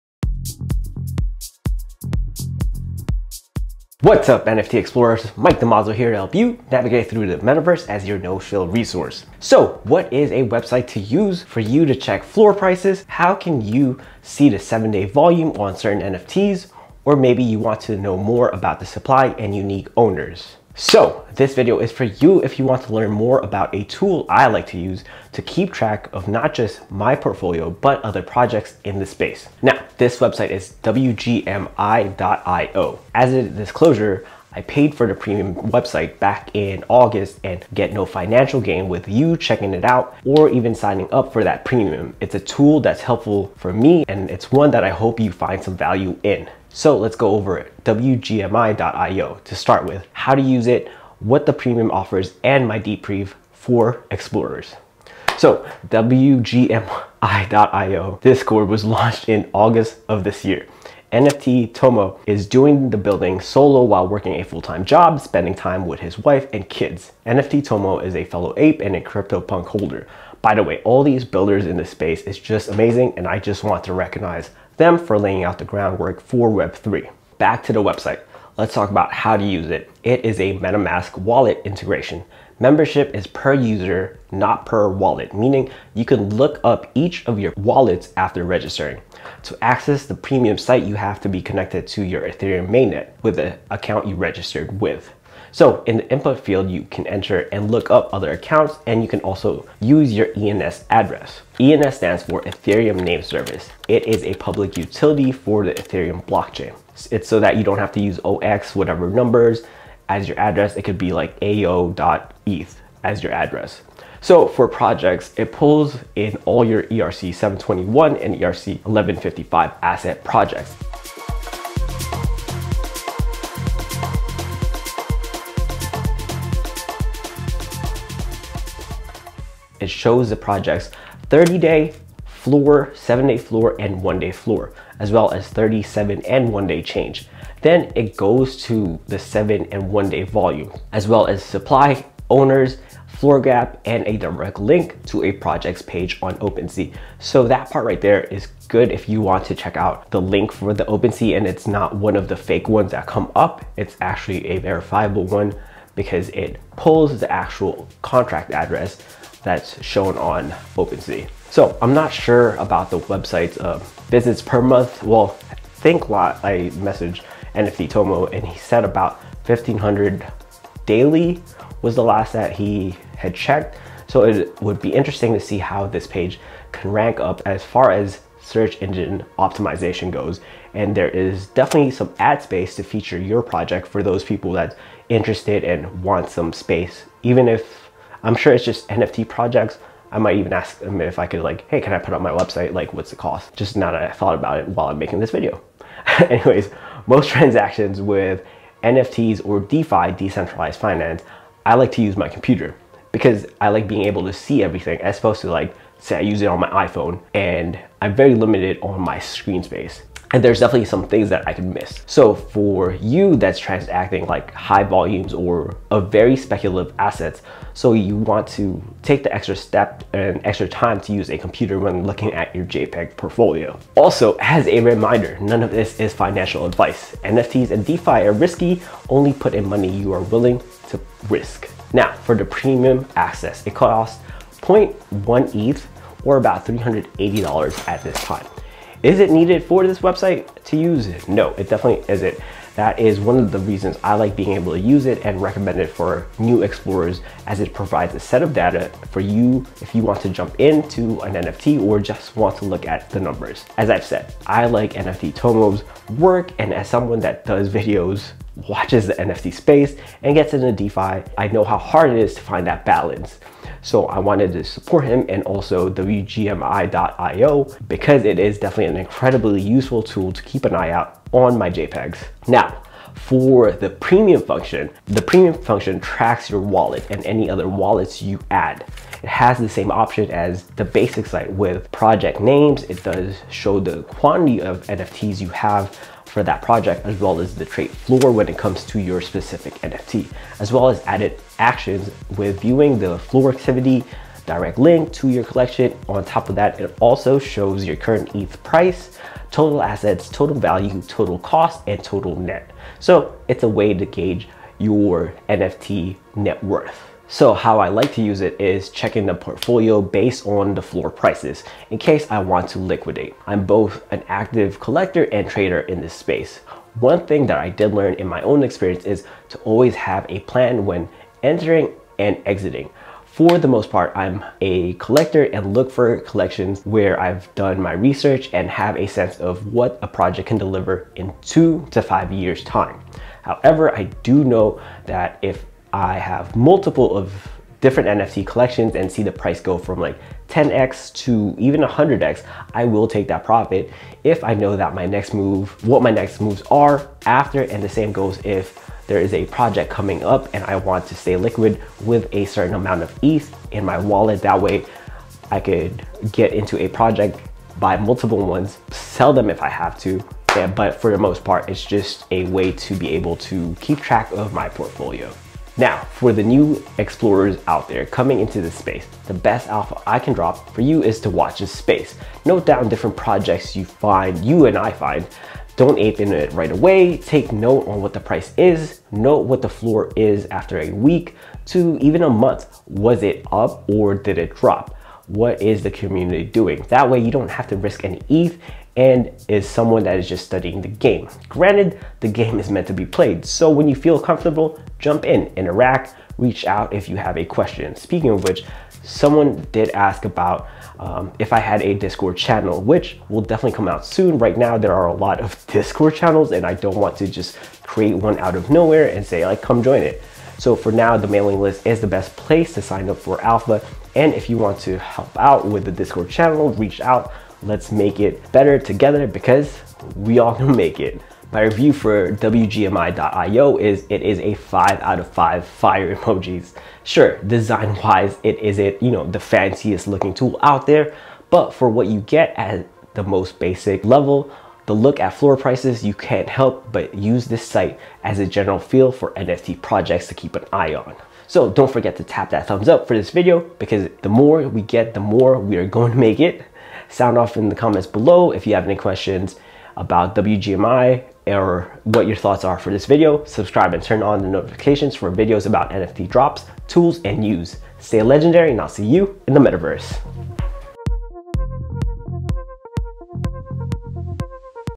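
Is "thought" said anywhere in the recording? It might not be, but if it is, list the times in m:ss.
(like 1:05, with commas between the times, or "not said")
3:14, 7:32.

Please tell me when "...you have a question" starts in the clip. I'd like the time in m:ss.
6:37.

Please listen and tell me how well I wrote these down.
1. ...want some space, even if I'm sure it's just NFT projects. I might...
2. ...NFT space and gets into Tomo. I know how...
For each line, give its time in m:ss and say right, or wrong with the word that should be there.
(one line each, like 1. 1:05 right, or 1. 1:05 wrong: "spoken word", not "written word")
1. 3:06 right
2. 4:19 wrong: "DeFi", not "Tomo".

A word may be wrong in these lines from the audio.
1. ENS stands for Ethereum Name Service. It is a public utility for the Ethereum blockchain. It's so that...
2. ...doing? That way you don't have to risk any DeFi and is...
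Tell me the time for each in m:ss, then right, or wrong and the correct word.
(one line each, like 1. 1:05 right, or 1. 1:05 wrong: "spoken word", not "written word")
1. 1:41 right
2. 6:26 wrong: "ETH", not "DeFi".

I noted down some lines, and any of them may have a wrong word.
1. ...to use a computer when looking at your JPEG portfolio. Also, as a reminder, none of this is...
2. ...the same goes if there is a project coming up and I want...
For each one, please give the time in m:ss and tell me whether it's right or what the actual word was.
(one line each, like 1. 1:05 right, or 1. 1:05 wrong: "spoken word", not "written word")
1. 3:41 right
2. 5:47 right.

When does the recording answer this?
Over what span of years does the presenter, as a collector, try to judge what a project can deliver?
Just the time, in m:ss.
5:31.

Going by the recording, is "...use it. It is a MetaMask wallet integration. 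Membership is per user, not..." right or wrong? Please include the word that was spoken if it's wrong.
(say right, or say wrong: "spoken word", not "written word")
right.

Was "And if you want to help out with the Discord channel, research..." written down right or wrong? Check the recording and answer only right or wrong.
wrong.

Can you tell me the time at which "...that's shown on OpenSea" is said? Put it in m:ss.
2:39.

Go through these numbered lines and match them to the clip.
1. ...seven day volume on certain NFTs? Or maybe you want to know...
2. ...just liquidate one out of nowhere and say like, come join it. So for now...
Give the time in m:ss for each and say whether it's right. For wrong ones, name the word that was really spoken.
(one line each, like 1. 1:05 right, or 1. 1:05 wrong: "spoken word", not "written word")
1. 0:14 right
2. 6:47 wrong: "create", not "liquidate".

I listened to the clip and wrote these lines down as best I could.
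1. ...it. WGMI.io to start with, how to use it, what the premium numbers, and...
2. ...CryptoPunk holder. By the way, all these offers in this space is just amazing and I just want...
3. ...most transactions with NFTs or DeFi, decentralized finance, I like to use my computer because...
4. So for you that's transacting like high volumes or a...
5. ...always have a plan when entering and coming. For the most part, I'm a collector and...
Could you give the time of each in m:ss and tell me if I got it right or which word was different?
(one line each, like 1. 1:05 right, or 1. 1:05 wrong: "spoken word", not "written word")
1. 0:47 wrong: "offers", not "numbers"
2. 1:09 wrong: "builders", not "offers"
3. 3:17 right
4. 3:32 right
5. 5:19 wrong: "exiting", not "coming".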